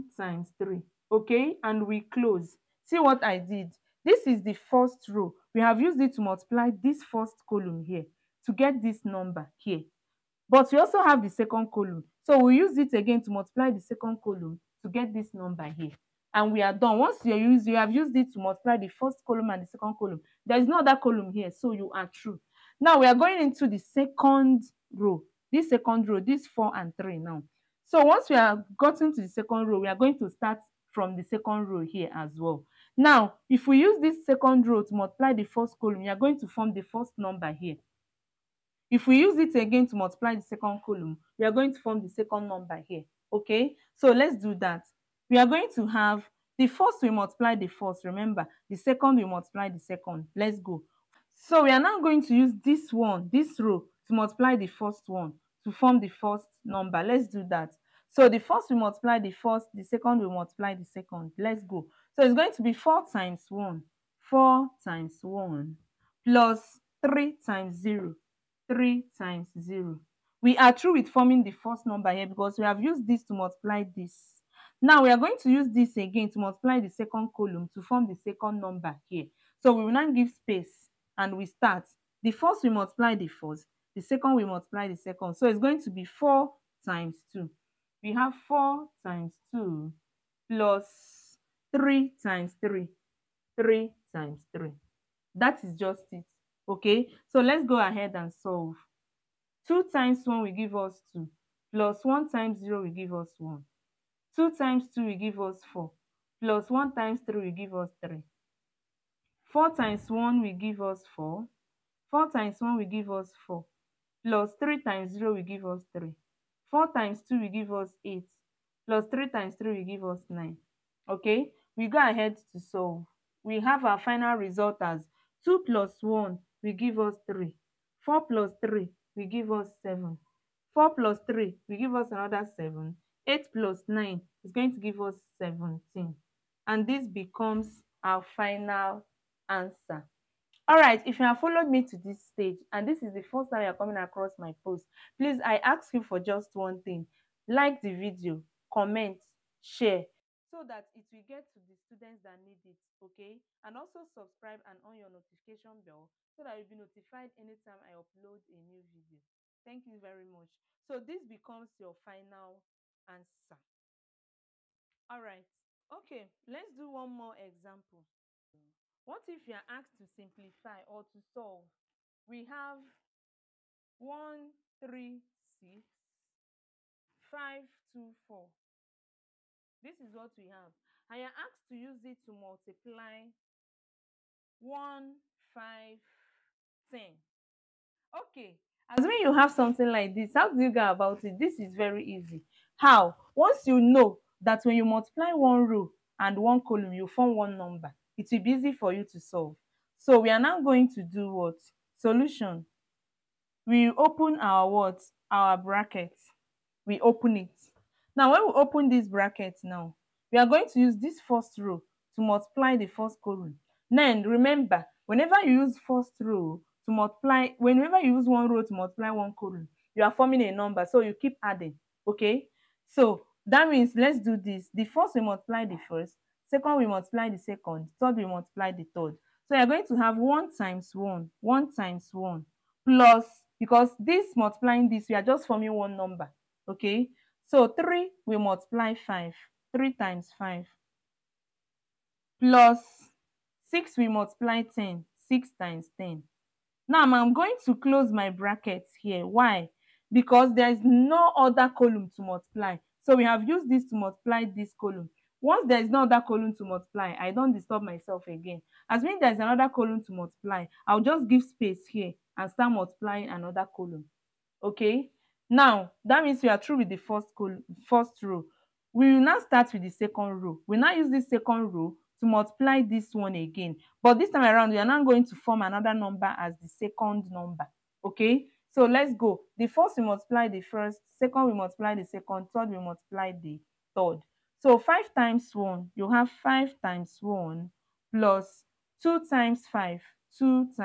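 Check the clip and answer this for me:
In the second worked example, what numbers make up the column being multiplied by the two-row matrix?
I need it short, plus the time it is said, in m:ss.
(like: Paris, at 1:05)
1, 5, 10, at 3:04.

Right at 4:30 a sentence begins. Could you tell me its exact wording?
We now use this second row to multiply this one again.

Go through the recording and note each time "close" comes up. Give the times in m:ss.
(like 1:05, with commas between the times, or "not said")
0:02, 4:07.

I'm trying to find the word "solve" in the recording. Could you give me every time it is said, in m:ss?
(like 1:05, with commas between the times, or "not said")
1:38, 2:02, 2:51, 3:19.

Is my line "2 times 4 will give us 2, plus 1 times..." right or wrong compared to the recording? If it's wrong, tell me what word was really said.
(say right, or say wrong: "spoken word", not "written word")
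wrong: "1", not "4".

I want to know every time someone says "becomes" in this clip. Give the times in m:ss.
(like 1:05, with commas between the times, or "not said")
2:17, 2:41.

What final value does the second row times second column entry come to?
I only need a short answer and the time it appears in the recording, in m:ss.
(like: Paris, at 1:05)
17, at 2:15.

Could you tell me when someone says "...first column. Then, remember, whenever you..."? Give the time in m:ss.
3:32.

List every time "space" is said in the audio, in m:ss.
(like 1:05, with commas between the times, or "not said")
1:20, 4:21.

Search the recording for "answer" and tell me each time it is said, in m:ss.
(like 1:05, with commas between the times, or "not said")
2:19, 2:43.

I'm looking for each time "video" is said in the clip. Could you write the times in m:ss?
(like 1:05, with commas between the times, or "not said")
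2:27, 2:38.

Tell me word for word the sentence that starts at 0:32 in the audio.
Now, if we use this second row to multiply the first column, we are going to form the first number here.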